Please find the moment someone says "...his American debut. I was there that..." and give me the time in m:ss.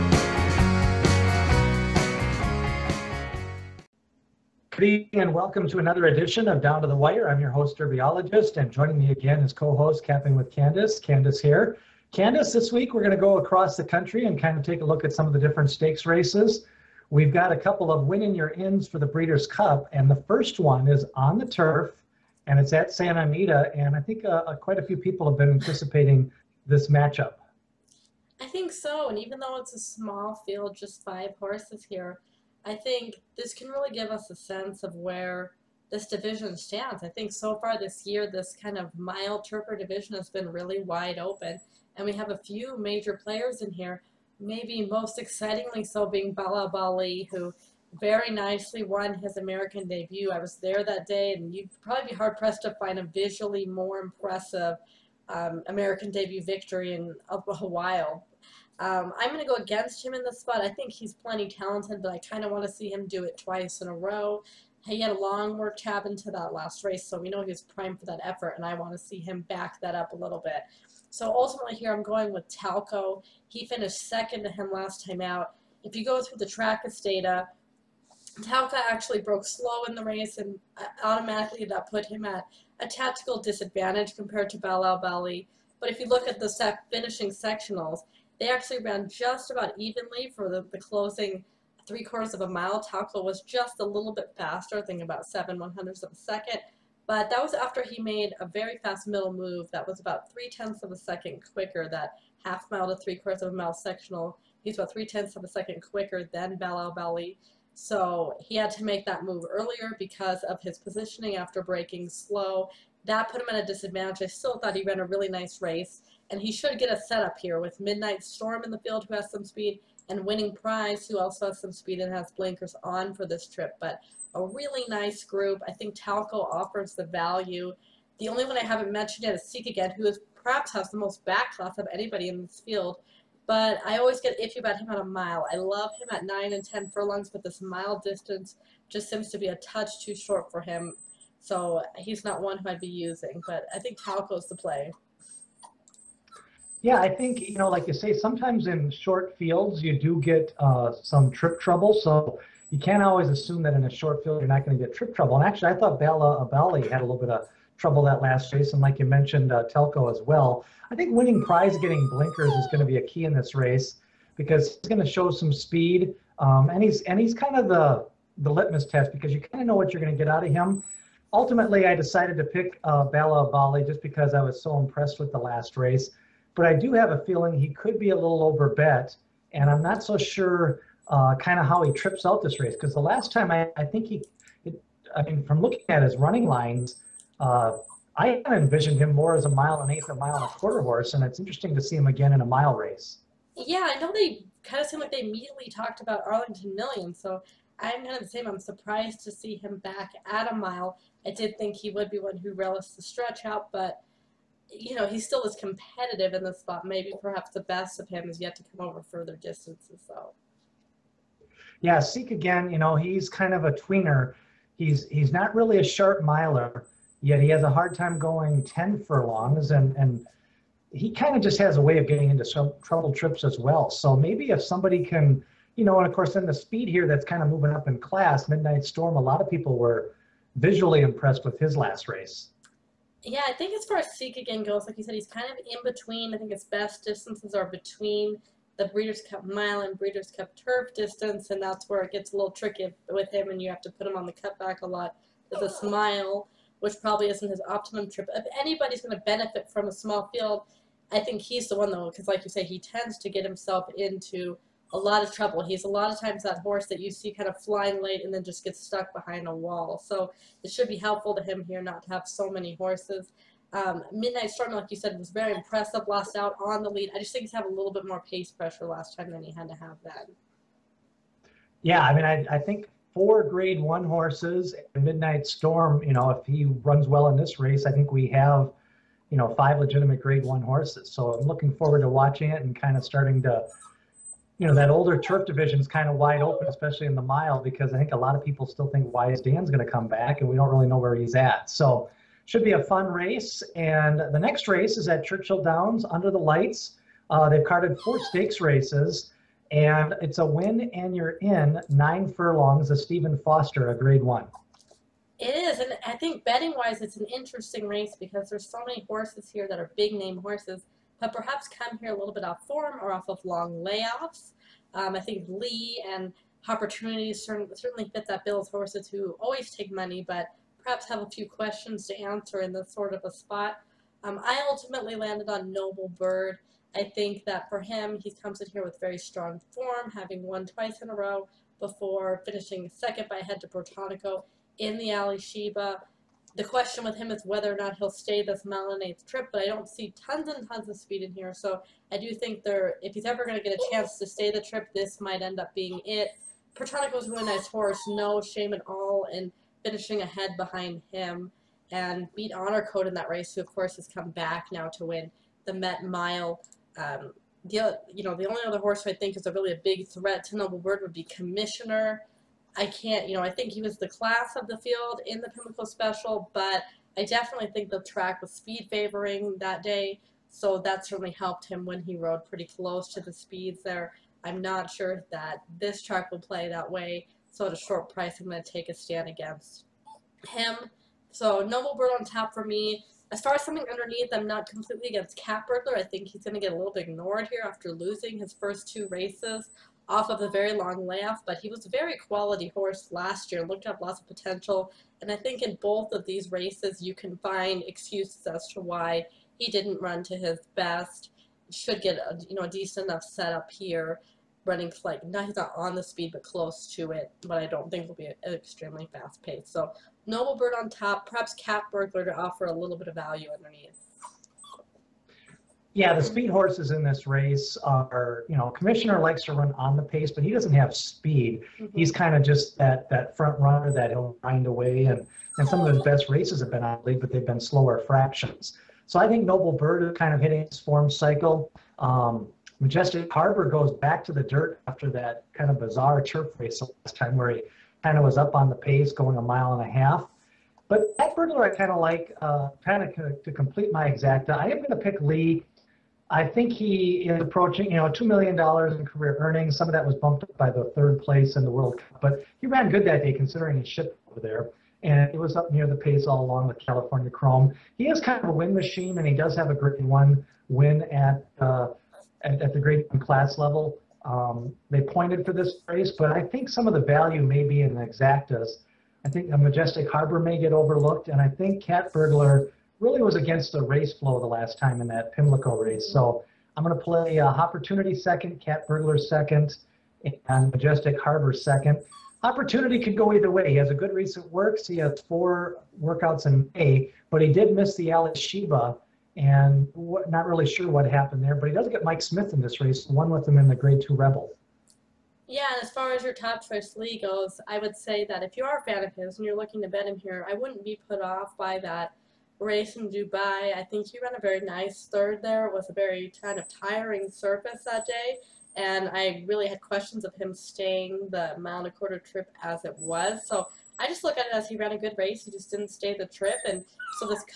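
0:49.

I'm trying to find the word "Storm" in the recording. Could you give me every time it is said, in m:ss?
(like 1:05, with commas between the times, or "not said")
1:58, 3:48, 4:24, 4:35.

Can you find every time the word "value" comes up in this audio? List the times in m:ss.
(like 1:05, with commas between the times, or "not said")
2:07, 6:53, 7:47.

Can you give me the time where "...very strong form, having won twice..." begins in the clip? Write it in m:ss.
5:28.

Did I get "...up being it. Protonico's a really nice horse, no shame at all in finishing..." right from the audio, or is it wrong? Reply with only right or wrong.
right.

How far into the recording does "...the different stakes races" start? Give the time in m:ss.
0:15.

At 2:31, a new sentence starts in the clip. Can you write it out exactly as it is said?
So you can't always assume that in a short field, you're not going to get trip trouble.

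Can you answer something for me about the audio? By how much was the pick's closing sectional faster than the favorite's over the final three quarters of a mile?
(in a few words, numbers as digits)
7 hundredths of a second.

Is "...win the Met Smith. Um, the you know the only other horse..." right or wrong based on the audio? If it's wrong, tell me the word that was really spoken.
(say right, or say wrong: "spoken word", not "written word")
wrong: "Mile", not "Smith".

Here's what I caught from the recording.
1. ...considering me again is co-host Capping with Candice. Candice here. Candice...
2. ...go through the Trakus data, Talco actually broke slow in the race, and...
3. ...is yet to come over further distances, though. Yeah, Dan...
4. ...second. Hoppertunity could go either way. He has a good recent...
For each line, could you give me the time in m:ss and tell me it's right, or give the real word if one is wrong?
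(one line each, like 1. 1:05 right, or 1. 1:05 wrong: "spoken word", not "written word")
1. 0:08 wrong: "joining", not "considering"
2. 1:16 right
3. 3:28 wrong: "Seek", not "Dan"
4. 8:01 right.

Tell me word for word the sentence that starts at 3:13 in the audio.
Yeah, I know they kind of seemed like they immediately talked about Arlington Million, so I'm kind of the same.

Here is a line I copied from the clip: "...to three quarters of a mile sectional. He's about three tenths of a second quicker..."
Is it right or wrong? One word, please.
right.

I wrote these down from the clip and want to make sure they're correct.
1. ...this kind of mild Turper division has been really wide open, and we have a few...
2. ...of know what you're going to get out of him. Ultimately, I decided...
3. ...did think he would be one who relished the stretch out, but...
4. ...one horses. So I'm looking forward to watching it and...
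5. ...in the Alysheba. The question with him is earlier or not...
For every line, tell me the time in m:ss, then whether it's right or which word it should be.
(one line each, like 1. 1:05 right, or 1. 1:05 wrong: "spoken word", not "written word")
1. 0:38 right
2. 2:49 right
3. 3:21 right
4. 4:40 right
5. 5:34 wrong: "whether", not "earlier".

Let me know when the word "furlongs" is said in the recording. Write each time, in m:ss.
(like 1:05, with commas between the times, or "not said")
2:16, 3:39, 5:02.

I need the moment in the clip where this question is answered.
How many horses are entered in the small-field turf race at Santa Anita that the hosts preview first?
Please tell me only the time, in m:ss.
0:31.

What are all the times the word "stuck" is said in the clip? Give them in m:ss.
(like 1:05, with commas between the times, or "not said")
4:18.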